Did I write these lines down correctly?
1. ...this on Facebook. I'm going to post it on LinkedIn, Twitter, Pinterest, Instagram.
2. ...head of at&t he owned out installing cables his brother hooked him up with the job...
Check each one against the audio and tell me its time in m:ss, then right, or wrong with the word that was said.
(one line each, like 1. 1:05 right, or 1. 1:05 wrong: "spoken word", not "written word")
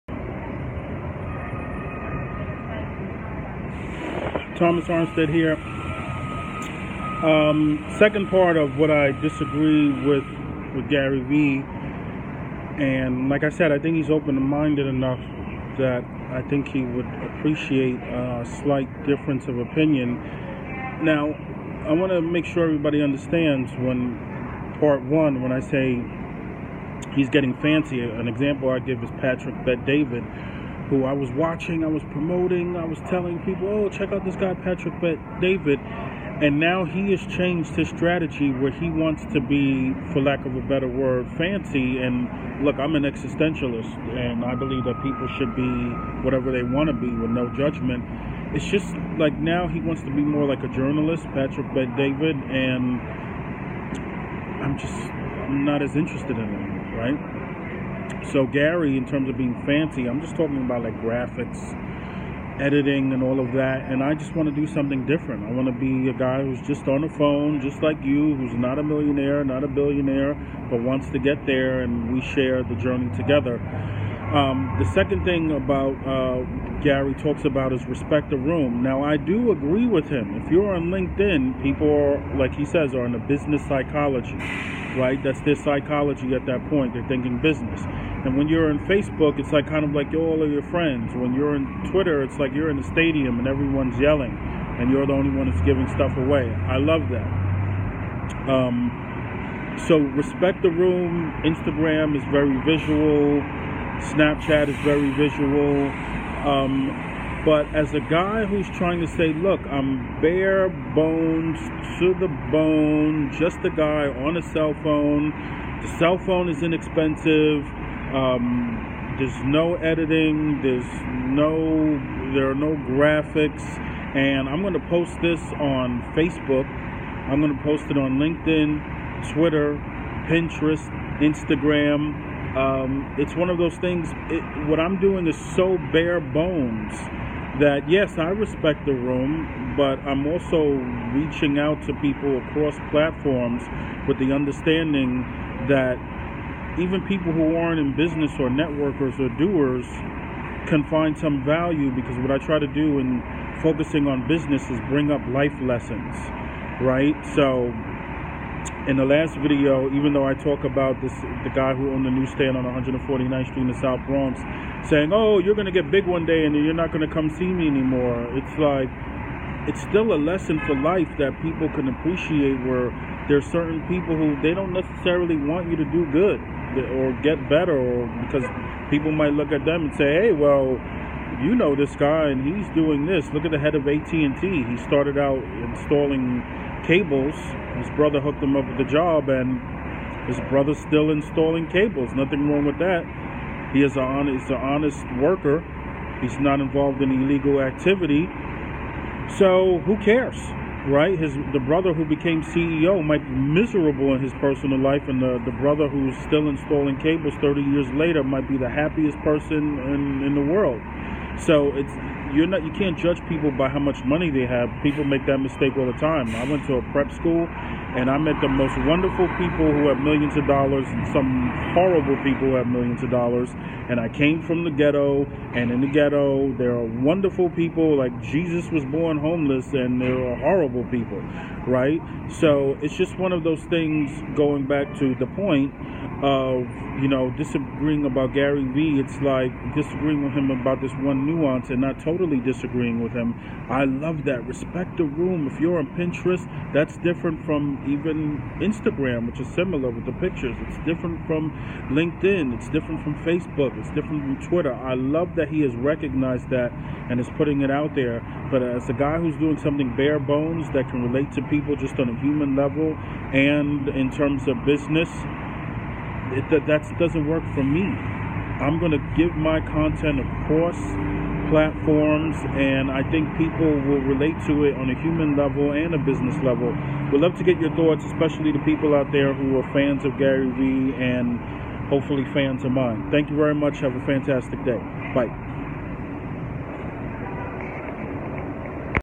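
1. 2:05 right
2. 3:03 wrong: "started", not "owned".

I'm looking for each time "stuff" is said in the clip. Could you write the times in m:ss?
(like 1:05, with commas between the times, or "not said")
1:35.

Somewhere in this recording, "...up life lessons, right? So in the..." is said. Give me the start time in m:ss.
2:35.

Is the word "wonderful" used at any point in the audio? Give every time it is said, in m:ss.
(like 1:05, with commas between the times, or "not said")
3:38, 3:46.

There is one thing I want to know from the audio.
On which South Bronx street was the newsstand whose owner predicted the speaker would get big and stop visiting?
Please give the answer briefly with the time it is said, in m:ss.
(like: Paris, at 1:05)
149th Street, at 2:42.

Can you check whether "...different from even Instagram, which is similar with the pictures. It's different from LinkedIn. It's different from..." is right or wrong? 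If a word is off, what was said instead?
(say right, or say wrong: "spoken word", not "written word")
right.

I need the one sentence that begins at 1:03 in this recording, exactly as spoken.
And I just want to do something different.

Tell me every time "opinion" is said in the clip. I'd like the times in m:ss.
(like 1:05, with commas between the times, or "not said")
0:19.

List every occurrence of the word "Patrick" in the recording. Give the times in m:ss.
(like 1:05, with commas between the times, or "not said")
0:29, 0:34, 0:51.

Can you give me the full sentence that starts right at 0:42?
And look, I'm an existentialist, and I believe that people should be whatever they want to be with no judgment.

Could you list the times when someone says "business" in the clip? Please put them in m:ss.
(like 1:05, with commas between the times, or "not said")
1:23, 1:27, 2:27, 2:34, 4:24, 4:35.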